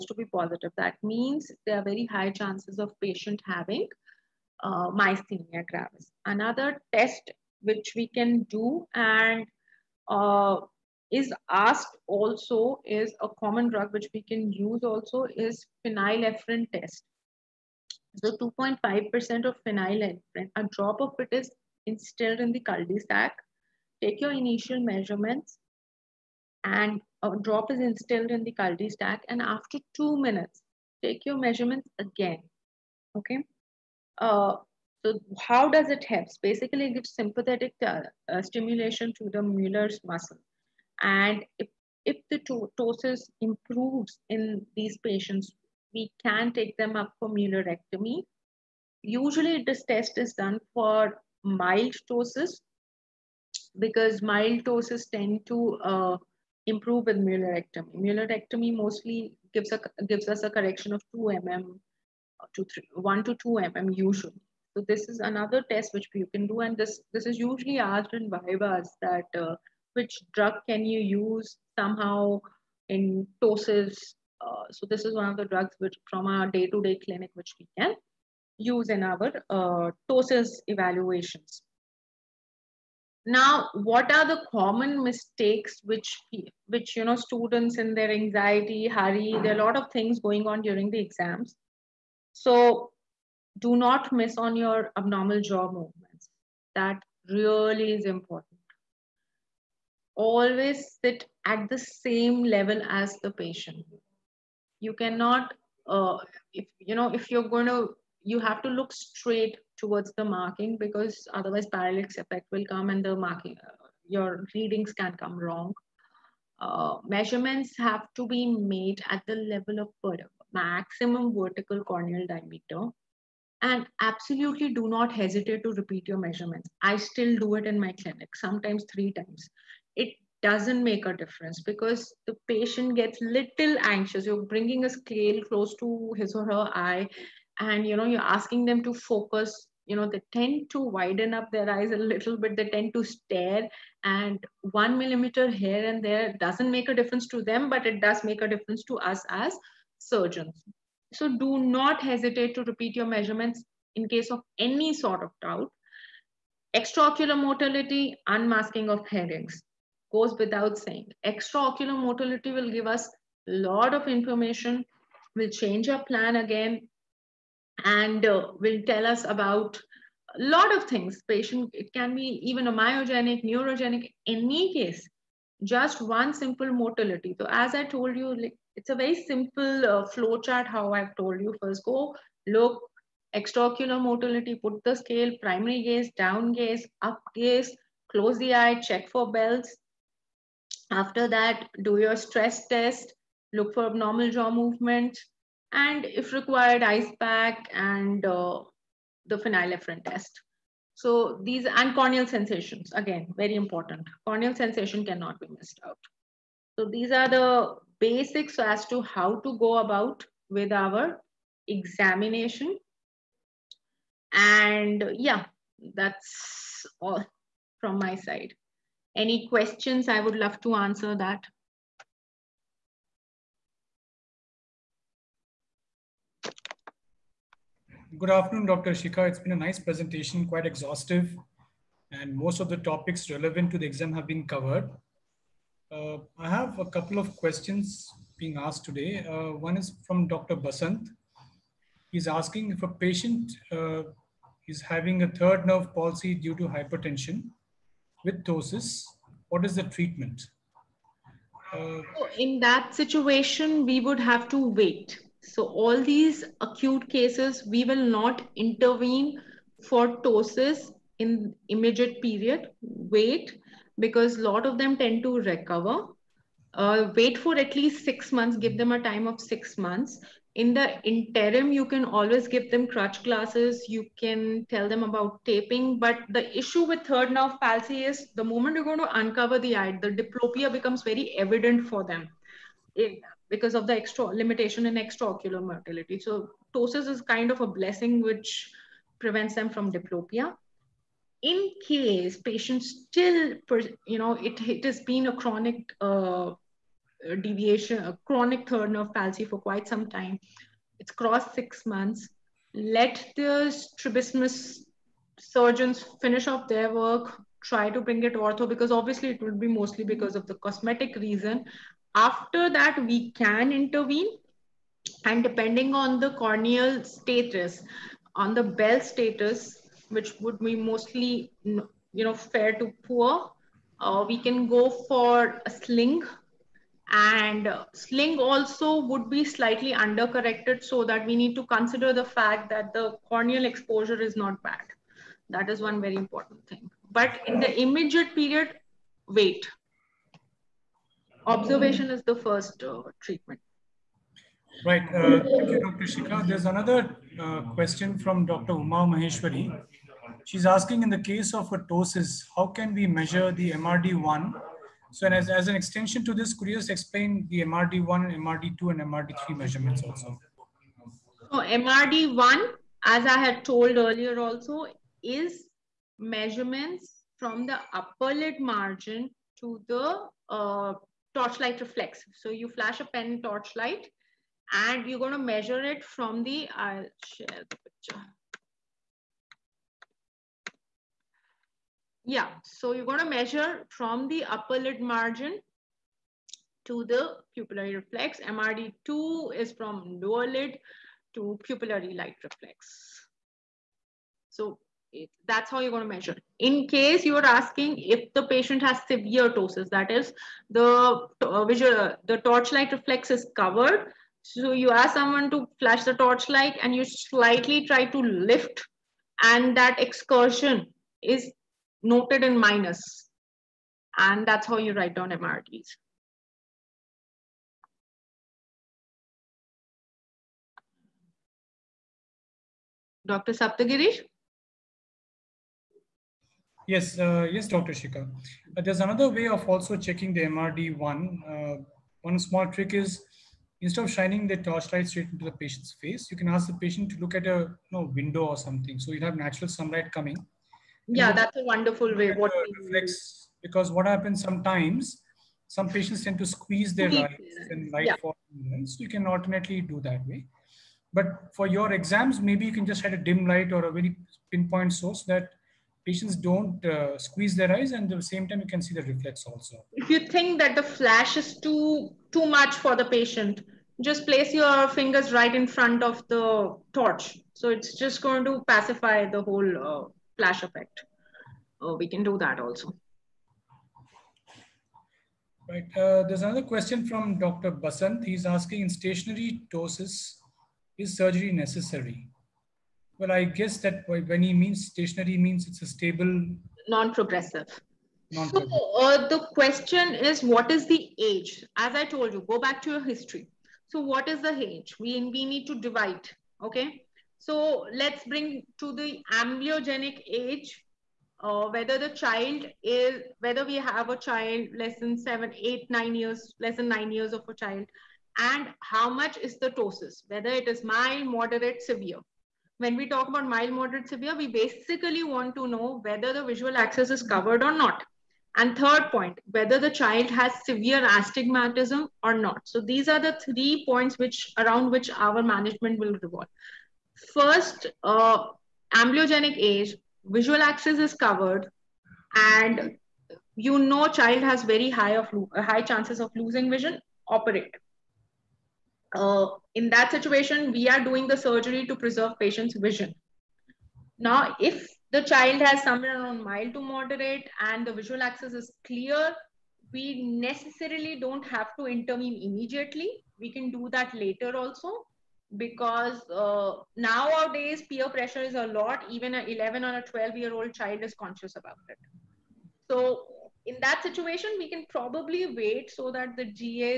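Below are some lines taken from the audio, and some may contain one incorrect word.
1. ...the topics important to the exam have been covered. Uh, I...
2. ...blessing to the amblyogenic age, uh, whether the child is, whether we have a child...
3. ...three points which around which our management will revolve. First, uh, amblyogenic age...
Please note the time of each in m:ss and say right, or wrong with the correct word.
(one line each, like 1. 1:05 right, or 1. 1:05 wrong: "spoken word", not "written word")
1. 3:52 wrong: "relevant", not "important"
2. 8:18 wrong: "bring", not "blessing"
3. 8:43 right.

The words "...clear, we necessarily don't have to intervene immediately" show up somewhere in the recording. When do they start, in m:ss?
9:08.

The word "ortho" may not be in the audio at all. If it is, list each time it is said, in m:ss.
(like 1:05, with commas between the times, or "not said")
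5:08.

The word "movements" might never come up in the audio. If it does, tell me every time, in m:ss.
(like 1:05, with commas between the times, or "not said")
1:35, 3:14.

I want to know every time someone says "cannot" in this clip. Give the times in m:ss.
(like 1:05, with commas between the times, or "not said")
1:44, 3:25.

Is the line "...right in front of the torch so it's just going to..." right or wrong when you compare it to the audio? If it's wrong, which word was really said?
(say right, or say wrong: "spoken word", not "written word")
right.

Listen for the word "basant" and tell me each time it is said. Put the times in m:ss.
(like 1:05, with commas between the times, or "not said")
4:00, 7:57.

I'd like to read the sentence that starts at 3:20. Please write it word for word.
So these and corneal sensations, again, very important.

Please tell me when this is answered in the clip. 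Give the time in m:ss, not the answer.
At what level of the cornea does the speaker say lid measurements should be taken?
2:00.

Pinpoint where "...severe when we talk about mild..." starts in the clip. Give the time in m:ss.
8:31.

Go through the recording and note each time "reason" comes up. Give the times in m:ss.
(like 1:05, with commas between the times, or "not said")
5:11.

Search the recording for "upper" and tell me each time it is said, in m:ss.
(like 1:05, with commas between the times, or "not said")
6:07, 6:24.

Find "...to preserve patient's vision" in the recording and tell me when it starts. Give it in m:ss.
9:01.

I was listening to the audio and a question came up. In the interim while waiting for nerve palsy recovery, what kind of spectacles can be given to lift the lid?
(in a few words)
crutch glasses.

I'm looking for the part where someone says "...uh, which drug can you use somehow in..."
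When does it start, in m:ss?
1:09.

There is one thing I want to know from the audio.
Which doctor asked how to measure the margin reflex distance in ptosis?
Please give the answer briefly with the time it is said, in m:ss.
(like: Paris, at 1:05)
Dr. Uma Maheshwari, at 5:48.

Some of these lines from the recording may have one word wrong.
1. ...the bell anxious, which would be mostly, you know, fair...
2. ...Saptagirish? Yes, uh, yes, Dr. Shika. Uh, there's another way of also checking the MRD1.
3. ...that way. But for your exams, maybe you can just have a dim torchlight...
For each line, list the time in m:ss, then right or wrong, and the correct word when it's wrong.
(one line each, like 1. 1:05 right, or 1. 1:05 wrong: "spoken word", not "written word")
1. 5:18 wrong: "status", not "anxious"
2. 7:03 right
3. 7:30 wrong: "light", not "torchlight".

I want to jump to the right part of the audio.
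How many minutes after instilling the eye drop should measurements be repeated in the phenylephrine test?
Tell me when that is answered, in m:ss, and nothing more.
0:29.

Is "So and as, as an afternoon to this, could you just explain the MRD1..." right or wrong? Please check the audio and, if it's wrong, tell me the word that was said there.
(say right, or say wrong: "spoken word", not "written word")
wrong: "extension", not "afternoon".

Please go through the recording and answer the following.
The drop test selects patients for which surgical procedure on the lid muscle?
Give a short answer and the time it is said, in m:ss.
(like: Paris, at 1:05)
Muellerectomy, at 0:47.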